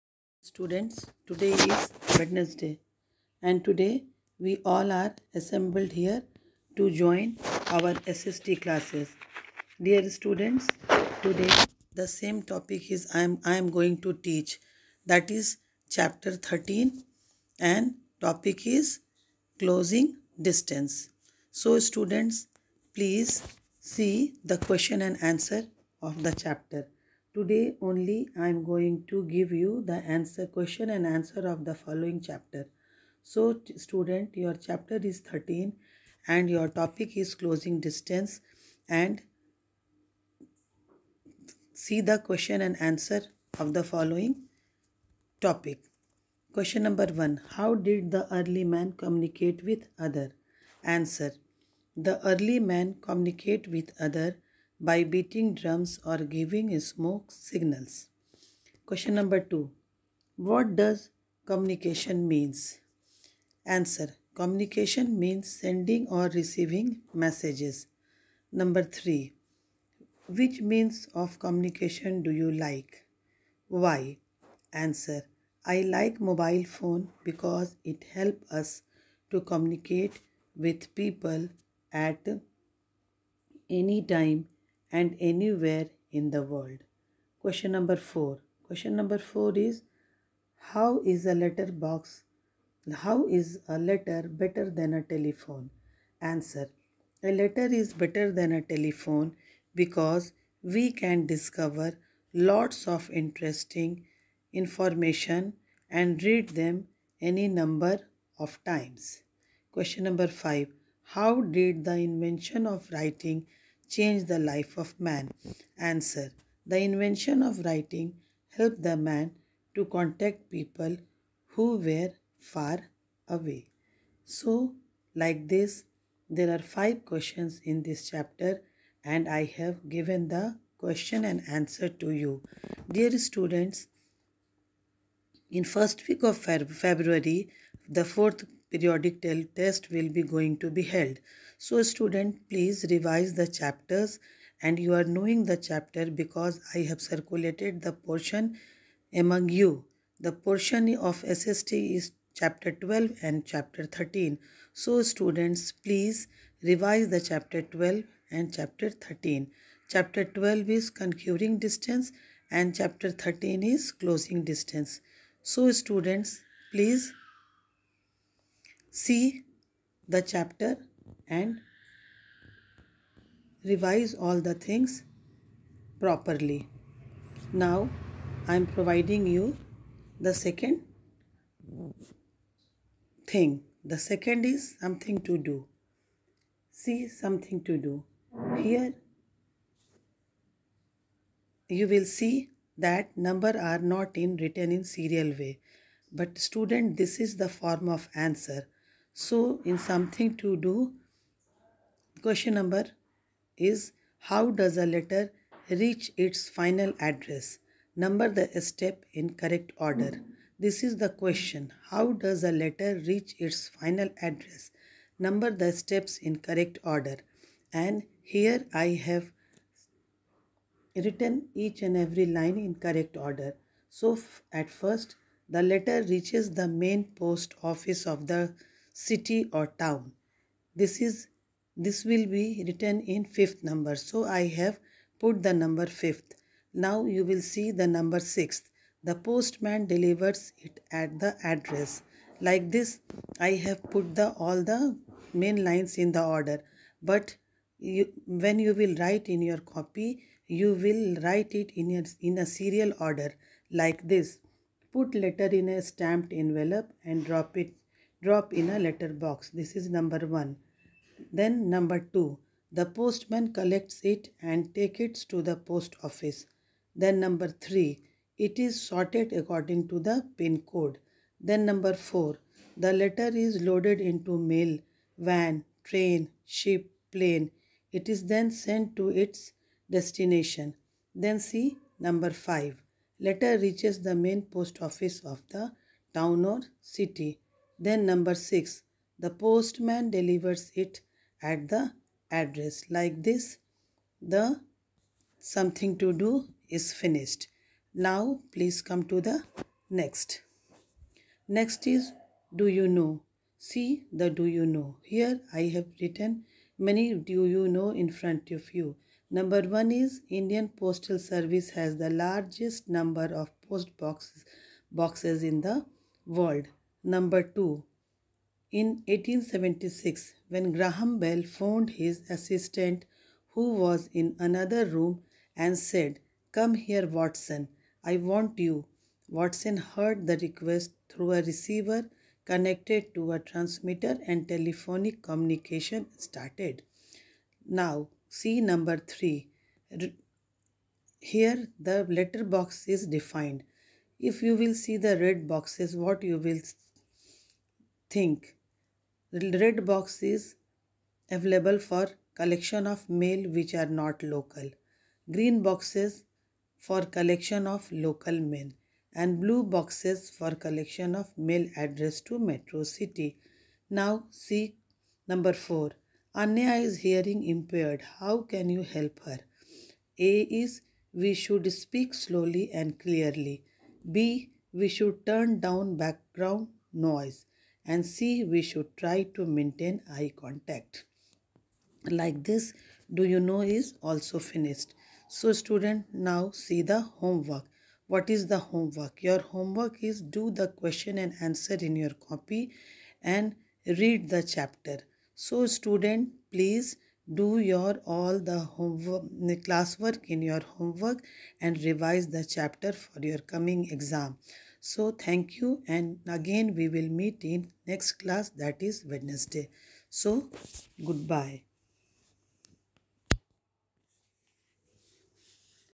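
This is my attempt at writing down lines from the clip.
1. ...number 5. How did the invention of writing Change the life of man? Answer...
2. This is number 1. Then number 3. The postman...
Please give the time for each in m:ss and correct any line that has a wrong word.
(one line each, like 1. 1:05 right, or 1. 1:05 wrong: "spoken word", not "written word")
1. 1:50 right
2. 4:19 wrong: "2", not "3".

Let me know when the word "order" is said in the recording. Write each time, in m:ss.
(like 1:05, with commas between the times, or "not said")
3:29, 3:36, 3:43, 4:06, 4:12.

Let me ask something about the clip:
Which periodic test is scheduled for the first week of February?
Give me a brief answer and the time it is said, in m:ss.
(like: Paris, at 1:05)
Fourth, at 2:18.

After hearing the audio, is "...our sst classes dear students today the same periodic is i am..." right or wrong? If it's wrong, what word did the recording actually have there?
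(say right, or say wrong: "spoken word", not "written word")
wrong: "topic", not "periodic".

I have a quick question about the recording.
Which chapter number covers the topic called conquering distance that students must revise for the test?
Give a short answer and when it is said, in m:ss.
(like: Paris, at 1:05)
12, at 2:39.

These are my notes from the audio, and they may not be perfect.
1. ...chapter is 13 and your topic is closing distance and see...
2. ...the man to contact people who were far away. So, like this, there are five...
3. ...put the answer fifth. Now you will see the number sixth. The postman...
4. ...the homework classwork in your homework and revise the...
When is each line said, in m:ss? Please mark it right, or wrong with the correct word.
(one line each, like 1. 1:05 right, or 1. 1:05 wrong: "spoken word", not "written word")
1. 0:34 right
2. 1:58 right
3. 3:55 wrong: "number", not "answer"
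4. 6:38 right.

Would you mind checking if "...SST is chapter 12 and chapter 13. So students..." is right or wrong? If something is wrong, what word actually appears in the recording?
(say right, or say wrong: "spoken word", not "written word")
right.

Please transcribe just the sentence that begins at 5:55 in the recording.
Green boxes for collection of local mail and blue boxes for collection of mail address to Metro City.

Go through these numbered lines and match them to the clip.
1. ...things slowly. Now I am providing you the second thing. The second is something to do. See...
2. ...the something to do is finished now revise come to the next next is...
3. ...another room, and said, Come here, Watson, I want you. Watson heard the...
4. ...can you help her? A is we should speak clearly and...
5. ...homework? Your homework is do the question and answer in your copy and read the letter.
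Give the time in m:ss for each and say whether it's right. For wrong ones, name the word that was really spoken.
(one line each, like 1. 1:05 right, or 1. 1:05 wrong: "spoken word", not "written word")
1. 2:54 wrong: "properly", not "slowly"
2. 4:54 wrong: "please", not "revise"
3. 5:24 right
4. 6:08 wrong: "slowly", not "clearly"
5. 6:28 wrong: "chapter", not "letter".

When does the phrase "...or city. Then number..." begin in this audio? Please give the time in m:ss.
4:46.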